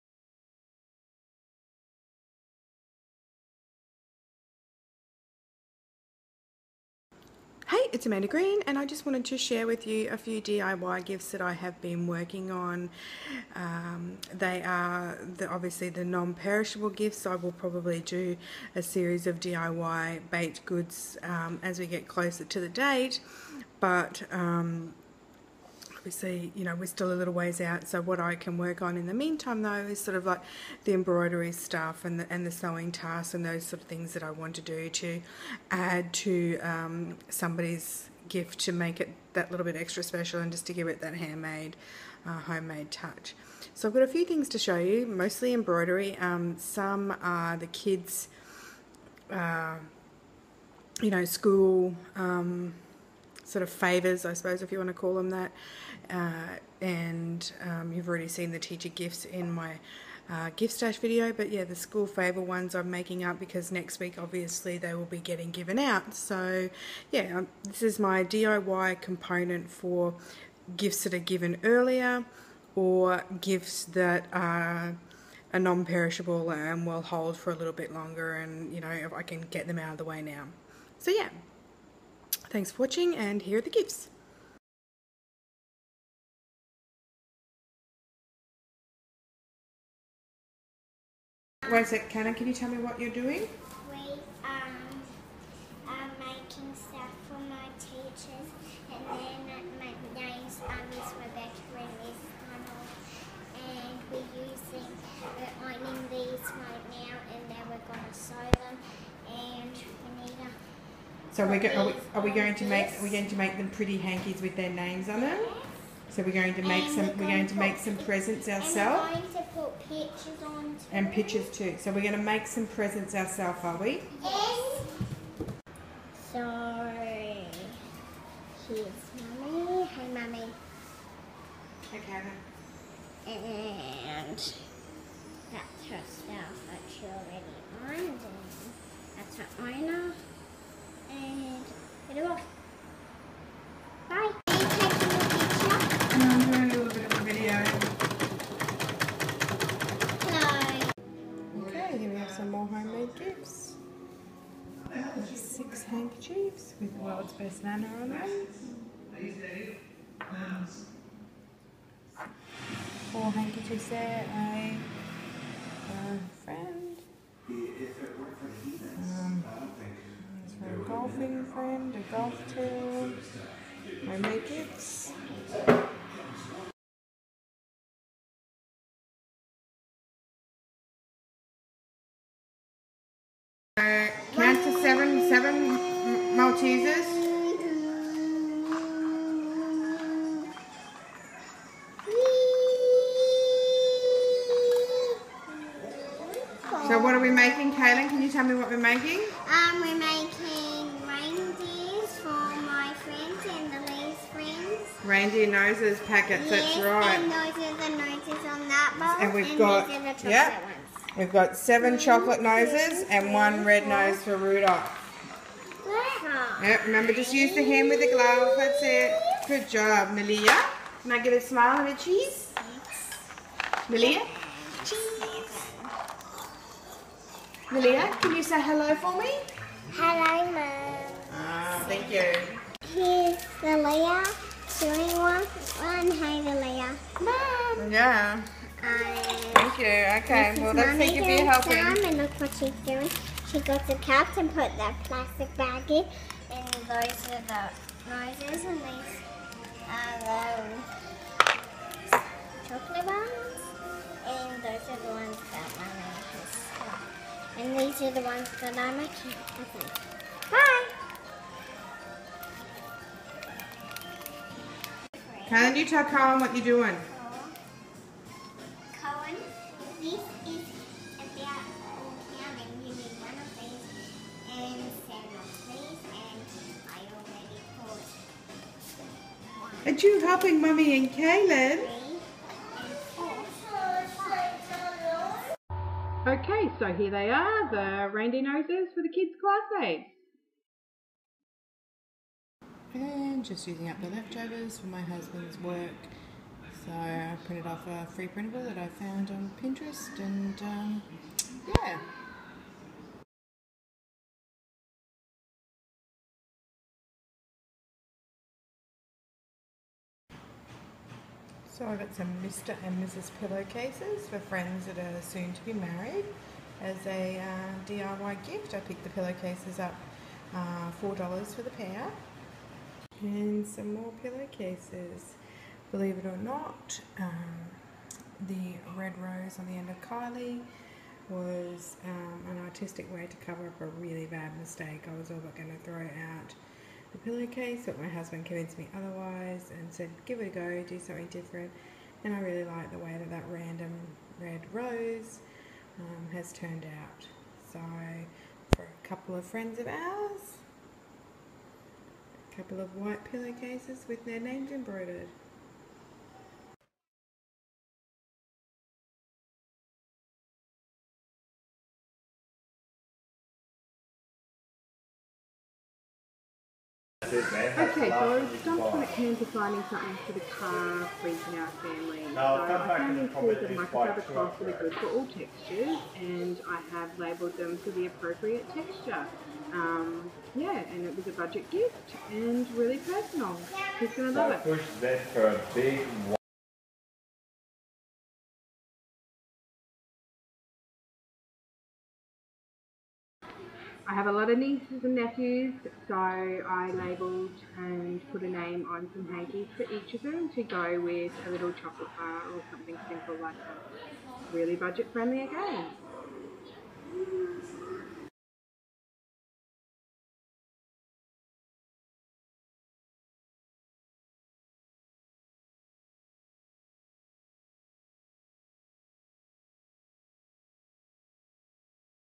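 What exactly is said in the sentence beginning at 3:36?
Yep, remember just use the hand with the glove, that's it.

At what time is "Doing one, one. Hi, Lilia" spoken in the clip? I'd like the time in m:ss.
3:54.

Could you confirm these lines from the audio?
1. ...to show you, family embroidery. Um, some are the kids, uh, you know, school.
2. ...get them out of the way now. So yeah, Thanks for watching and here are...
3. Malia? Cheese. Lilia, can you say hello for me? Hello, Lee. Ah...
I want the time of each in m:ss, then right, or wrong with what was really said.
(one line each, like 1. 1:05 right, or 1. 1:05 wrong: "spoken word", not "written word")
1. 0:44 wrong: "mostly", not "family"
2. 1:19 right
3. 3:43 wrong: "Mum", not "Lee".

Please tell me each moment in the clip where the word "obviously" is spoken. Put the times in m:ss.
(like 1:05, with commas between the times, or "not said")
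0:15, 1:04.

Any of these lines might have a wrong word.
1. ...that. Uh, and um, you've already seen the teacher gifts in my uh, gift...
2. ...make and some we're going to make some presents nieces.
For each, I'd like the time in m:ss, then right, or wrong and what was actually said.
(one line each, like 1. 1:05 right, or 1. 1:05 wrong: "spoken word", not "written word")
1. 0:55 right
2. 1:56 wrong: "ourselves", not "nieces".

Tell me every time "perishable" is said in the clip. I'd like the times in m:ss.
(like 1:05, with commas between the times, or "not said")
0:16, 1:15.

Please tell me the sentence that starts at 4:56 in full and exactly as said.
So I printed off a free printable that I found on Pinterest and um, yeah.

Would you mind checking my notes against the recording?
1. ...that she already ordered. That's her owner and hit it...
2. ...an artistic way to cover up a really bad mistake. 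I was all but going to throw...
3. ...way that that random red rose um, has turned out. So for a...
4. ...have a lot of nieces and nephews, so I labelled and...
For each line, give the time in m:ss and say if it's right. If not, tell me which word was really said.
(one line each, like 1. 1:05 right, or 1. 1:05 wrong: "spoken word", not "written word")
1. 2:16 right
2. 5:32 right
3. 5:42 right
4. 6:34 right.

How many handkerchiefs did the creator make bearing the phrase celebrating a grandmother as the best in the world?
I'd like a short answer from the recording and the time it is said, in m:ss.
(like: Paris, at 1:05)
6, at 2:35.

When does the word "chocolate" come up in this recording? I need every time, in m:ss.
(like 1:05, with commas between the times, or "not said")
3:31, 6:41.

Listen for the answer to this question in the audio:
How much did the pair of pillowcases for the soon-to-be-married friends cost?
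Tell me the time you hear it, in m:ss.
5:21.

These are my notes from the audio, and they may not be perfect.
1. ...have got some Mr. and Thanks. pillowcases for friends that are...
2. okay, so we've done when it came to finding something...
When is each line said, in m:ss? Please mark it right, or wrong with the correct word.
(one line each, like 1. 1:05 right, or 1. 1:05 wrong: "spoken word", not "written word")
1. 5:11 wrong: "Mrs", not "Thanks"
2. 6:07 right.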